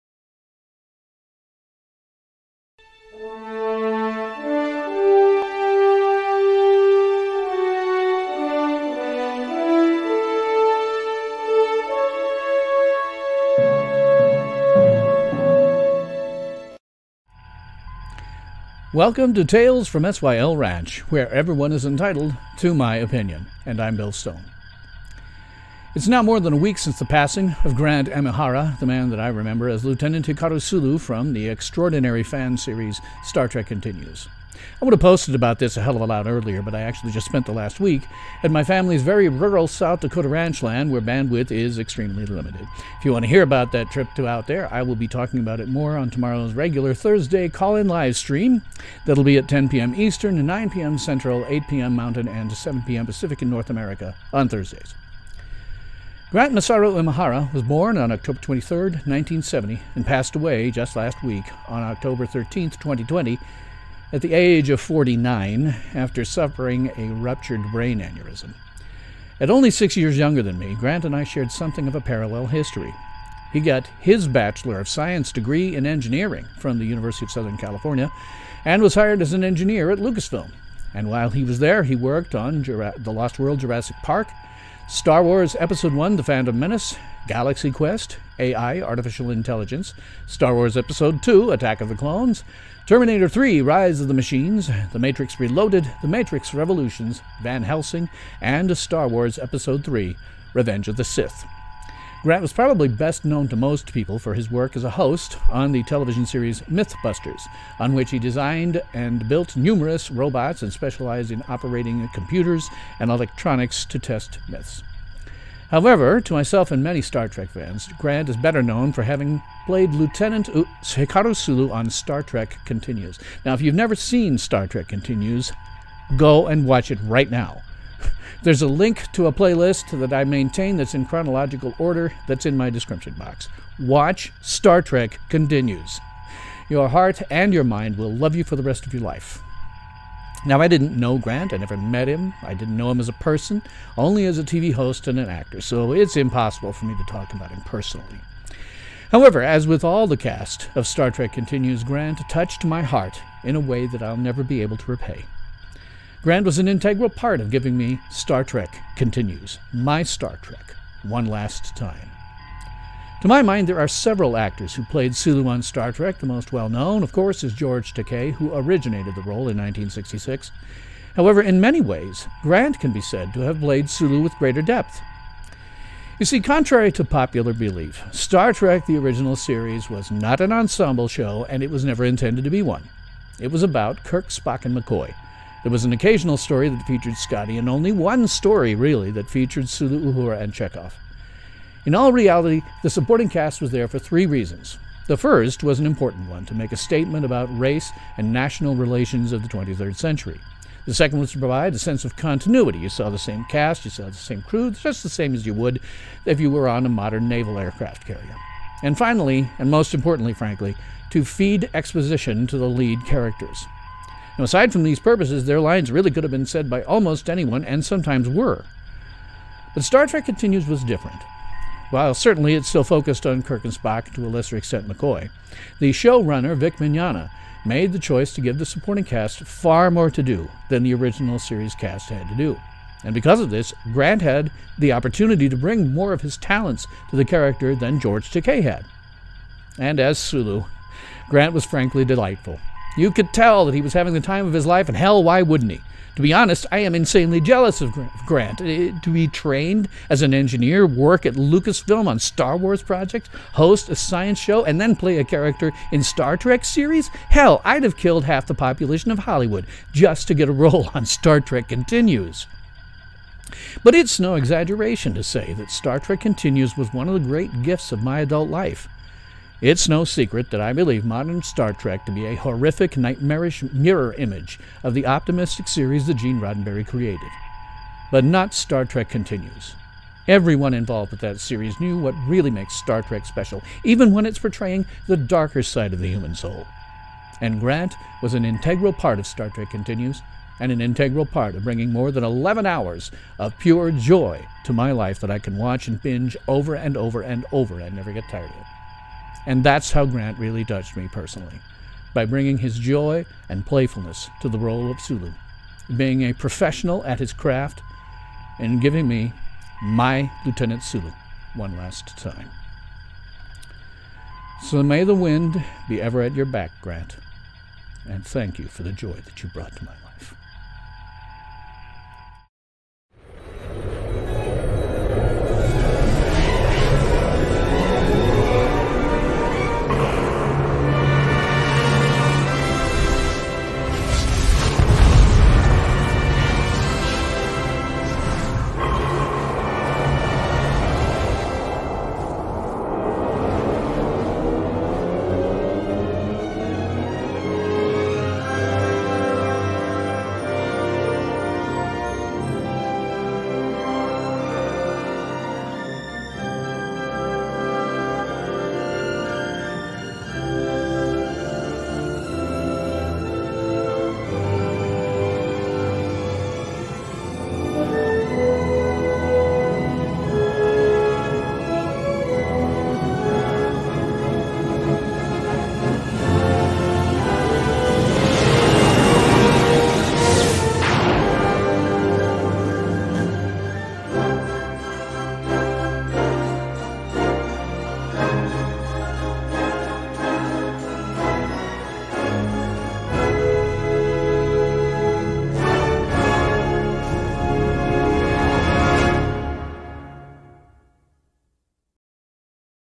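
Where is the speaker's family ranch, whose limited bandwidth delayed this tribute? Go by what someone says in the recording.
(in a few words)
South Dakota.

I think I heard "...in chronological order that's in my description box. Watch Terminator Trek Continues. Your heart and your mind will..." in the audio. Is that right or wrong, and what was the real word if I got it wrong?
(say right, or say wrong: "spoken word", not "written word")
wrong: "Star", not "Terminator".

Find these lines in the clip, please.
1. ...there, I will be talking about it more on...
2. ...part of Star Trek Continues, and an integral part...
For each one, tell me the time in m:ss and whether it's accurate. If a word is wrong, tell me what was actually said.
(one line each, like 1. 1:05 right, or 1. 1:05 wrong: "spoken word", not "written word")
1. 0:44 right
2. 4:48 right.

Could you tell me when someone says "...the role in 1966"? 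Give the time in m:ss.
2:49.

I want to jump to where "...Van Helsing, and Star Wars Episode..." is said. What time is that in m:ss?
1:37.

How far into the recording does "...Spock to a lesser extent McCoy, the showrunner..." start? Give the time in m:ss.
3:43.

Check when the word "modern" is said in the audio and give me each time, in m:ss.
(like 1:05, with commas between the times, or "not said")
3:26, 4:31.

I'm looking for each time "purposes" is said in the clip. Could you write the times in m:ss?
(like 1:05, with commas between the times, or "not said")
3:34.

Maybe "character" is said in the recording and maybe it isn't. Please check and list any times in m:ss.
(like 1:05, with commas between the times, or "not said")
3:33, 3:57, 4:15.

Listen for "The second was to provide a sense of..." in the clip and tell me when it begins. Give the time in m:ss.
3:20.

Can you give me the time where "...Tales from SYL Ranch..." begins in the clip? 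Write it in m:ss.
0:19.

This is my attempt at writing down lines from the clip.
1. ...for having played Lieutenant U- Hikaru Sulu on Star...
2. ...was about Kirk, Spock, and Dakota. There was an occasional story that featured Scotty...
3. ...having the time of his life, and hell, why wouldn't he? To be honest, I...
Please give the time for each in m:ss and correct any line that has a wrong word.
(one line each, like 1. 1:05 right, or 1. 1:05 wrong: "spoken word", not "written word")
1. 1:58 right
2. 3:03 wrong: "McCoy", not "Dakota"
3. 4:03 right.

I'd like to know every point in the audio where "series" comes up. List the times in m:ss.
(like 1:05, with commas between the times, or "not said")
0:32, 1:46, 2:59, 3:51, 4:16, 4:35, 4:41.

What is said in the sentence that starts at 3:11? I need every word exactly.
In all reality, the supporting cast was there for three reasons.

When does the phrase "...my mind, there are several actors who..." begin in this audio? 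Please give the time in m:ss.
2:43.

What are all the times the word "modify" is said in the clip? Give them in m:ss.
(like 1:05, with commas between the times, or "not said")
not said.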